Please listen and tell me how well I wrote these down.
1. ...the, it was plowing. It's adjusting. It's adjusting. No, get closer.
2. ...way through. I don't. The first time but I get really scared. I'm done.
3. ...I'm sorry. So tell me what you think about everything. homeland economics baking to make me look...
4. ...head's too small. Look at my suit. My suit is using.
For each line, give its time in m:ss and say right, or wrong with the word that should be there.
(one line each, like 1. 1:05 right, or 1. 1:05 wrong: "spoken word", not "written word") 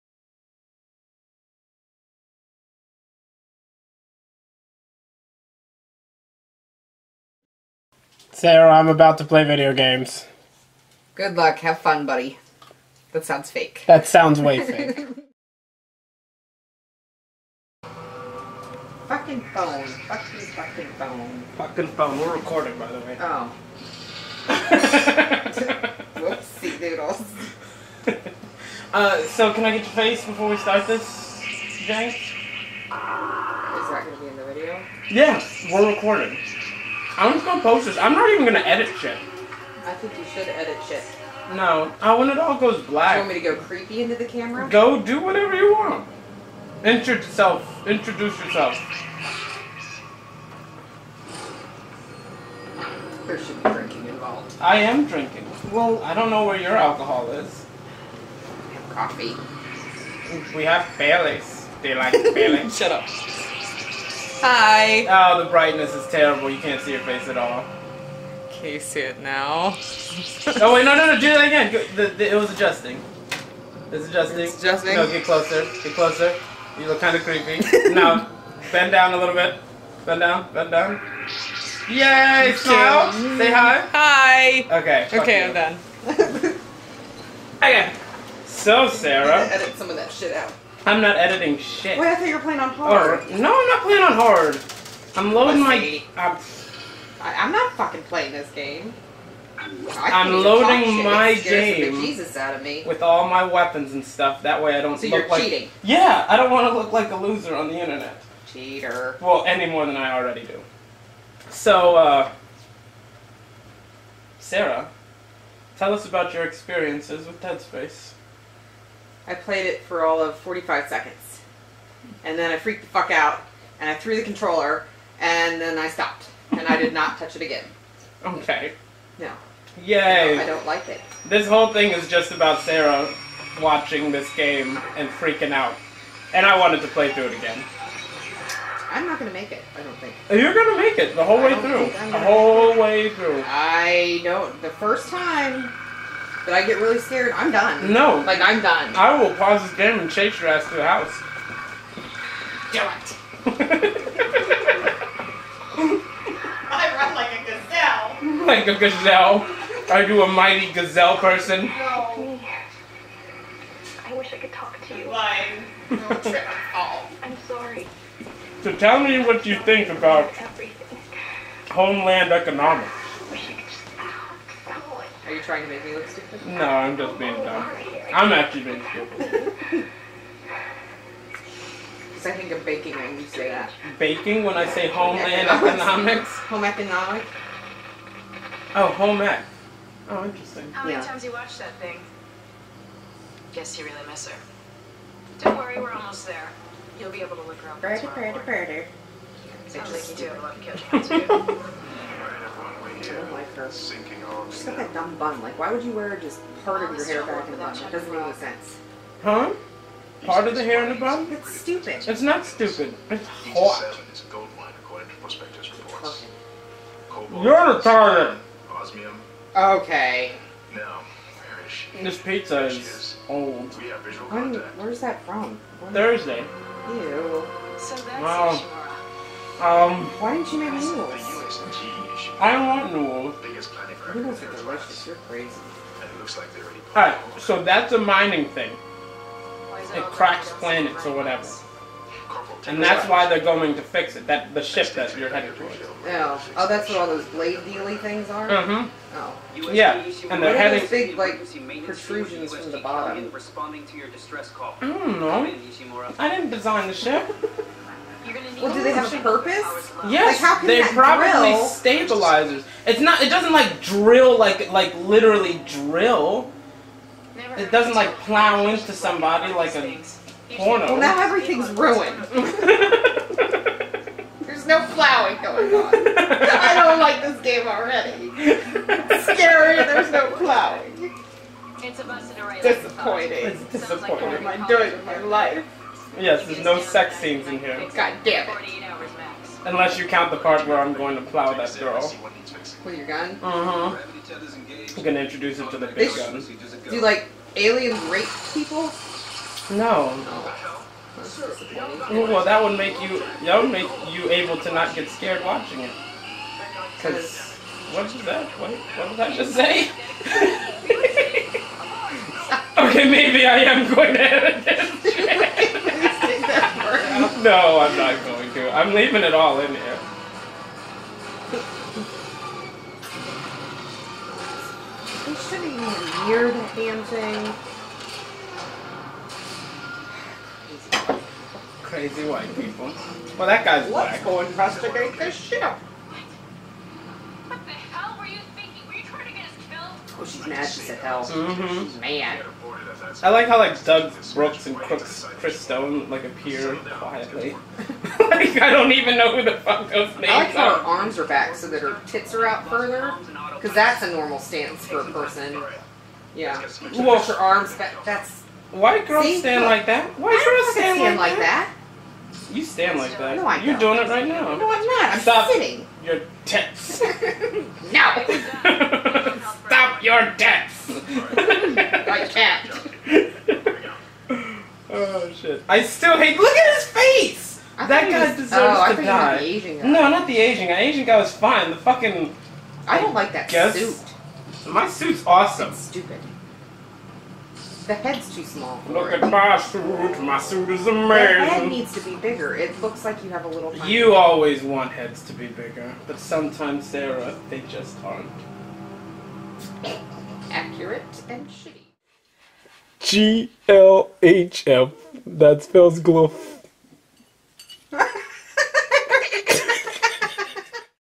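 1. 1:12 wrong: "adjusting", not "plowing"
2. 2:22 right
3. 2:46 wrong: "trying", not "baking"
4. 6:27 wrong: "amazing", not "using".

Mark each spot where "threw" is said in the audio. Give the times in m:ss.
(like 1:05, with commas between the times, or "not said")
2:03.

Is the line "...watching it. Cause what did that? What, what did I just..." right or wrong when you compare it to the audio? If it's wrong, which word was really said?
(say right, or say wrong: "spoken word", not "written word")
right.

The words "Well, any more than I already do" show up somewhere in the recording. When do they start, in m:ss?
1:49.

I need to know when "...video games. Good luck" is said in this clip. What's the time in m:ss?
0:09.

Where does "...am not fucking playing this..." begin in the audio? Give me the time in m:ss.
1:37.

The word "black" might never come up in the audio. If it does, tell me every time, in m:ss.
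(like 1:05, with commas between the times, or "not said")
0:42, 5:34.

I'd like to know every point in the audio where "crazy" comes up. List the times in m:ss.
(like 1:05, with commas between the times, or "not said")
3:55, 5:31.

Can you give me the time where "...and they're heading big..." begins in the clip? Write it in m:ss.
4:10.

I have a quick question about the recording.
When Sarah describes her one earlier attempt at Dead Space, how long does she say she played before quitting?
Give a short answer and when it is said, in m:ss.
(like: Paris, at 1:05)
45 seconds, at 2:00.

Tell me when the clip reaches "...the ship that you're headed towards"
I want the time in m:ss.
4:04.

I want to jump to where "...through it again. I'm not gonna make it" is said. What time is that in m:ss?
2:17.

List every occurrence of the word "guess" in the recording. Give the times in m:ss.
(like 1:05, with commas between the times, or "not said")
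3:13, 6:23.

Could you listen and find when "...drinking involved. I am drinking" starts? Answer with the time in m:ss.
0:53.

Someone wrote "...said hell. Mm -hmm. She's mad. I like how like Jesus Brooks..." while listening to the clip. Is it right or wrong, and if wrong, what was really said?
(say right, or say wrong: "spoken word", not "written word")
wrong: "Doug", not "Jesus".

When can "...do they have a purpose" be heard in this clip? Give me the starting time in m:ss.
4:18.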